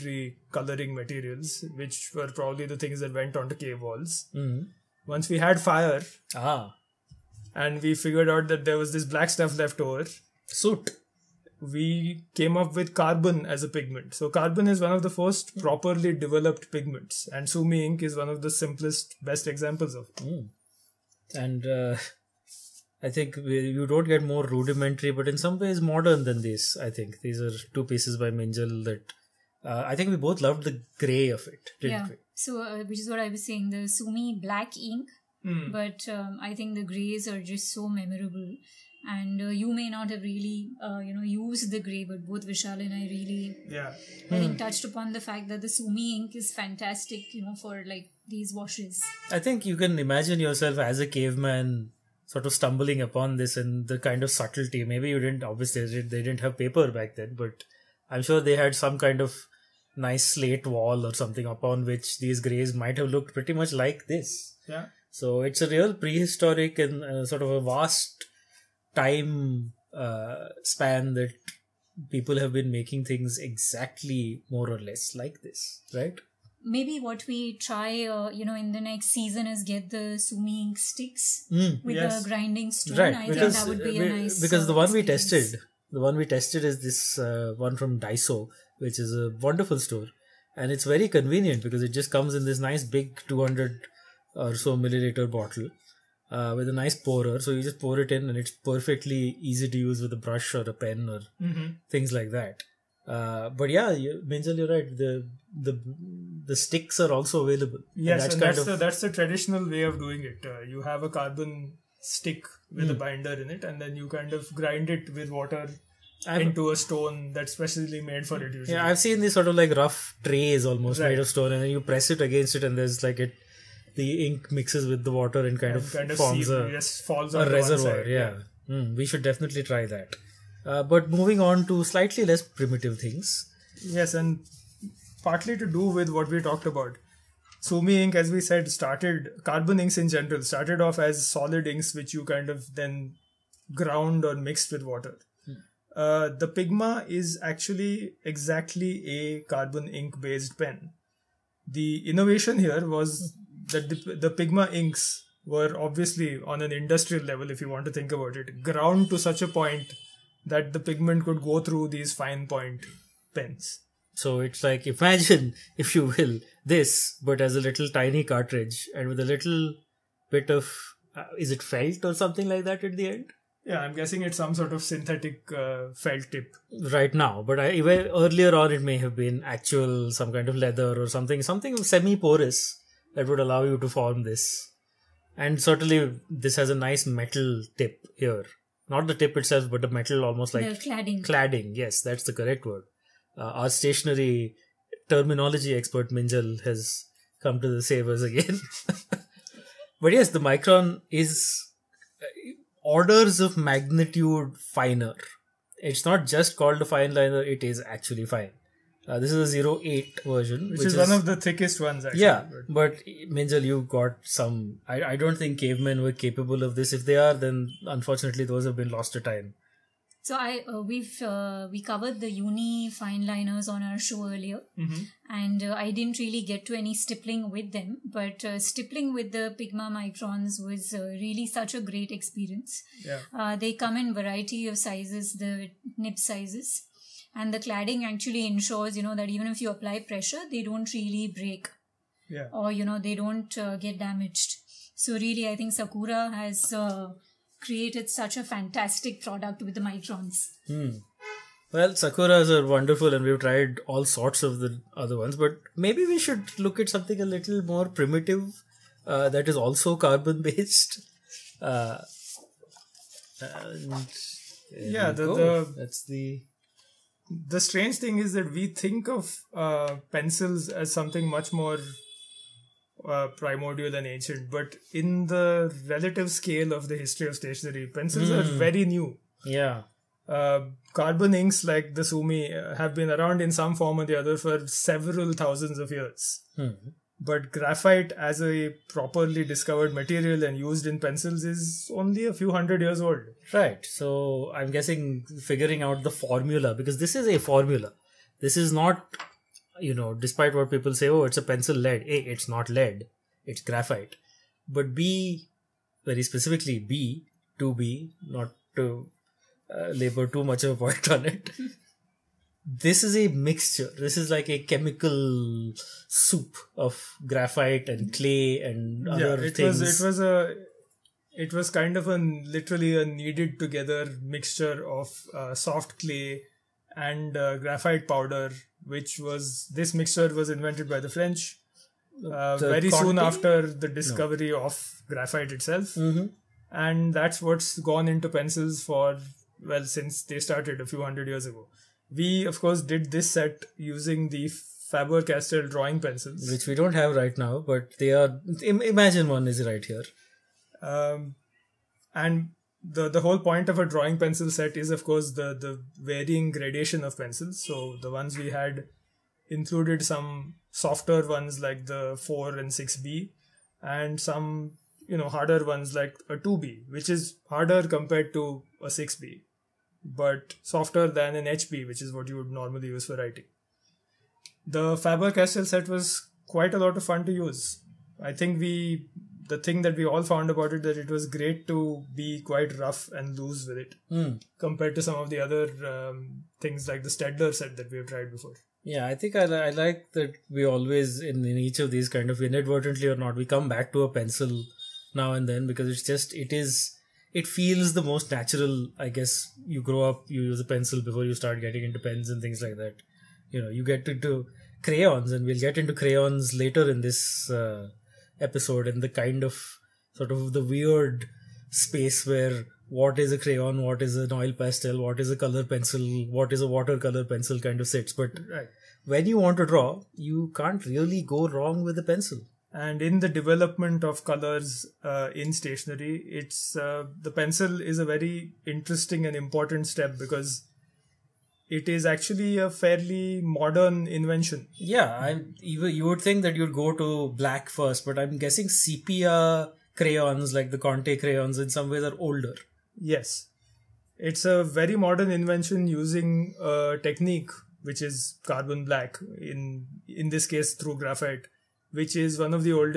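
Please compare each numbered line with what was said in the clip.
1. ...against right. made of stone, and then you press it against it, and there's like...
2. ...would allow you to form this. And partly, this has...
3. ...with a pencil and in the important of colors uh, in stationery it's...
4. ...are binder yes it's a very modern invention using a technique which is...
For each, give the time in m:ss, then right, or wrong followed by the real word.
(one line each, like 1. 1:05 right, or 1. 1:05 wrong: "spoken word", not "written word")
1. 2:00 wrong: "almost", not "against"
2. 3:03 wrong: "certainly", not "partly"
3. 7:01 wrong: "development", not "important"
4. 7:22 wrong: "older", not "binder".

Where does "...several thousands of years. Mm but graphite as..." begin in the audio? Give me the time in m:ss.
4:44.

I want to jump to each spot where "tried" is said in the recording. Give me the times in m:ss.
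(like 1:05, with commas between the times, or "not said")
4:13, 6:28.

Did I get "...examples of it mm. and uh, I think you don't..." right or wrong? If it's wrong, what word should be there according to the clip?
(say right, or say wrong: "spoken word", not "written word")
right.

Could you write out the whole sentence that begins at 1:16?
maybe what we try, uh, you know, in the next season is get the sumi ink sticks mm, with yes.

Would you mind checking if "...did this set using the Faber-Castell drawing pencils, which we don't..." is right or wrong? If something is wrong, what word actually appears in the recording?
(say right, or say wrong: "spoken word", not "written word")
right.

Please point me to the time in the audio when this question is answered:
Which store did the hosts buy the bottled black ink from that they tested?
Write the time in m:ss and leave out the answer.
1:27.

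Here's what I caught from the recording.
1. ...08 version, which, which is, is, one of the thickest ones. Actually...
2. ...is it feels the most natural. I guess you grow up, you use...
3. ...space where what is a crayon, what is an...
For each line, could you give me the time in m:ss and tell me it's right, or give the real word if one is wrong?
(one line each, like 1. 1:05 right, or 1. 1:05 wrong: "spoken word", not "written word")
1. 3:29 right
2. 6:36 right
3. 6:51 right.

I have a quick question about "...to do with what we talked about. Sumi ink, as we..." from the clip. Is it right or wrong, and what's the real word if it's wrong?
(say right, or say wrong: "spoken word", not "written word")
right.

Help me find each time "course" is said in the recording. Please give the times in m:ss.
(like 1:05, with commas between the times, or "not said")
5:42, 5:55.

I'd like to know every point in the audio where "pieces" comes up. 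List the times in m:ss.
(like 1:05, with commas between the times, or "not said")
0:27.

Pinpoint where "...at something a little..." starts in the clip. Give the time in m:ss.
4:16.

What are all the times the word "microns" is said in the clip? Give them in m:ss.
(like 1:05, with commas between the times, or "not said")
3:20, 3:49, 4:09.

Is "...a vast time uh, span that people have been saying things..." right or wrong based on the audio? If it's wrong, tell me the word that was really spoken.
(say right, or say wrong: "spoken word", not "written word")
wrong: "making", not "saying".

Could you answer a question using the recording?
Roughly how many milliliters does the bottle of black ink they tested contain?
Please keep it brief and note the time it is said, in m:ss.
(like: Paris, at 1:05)
200, at 1:33.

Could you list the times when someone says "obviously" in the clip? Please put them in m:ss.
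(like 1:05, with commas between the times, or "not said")
0:55, 2:35.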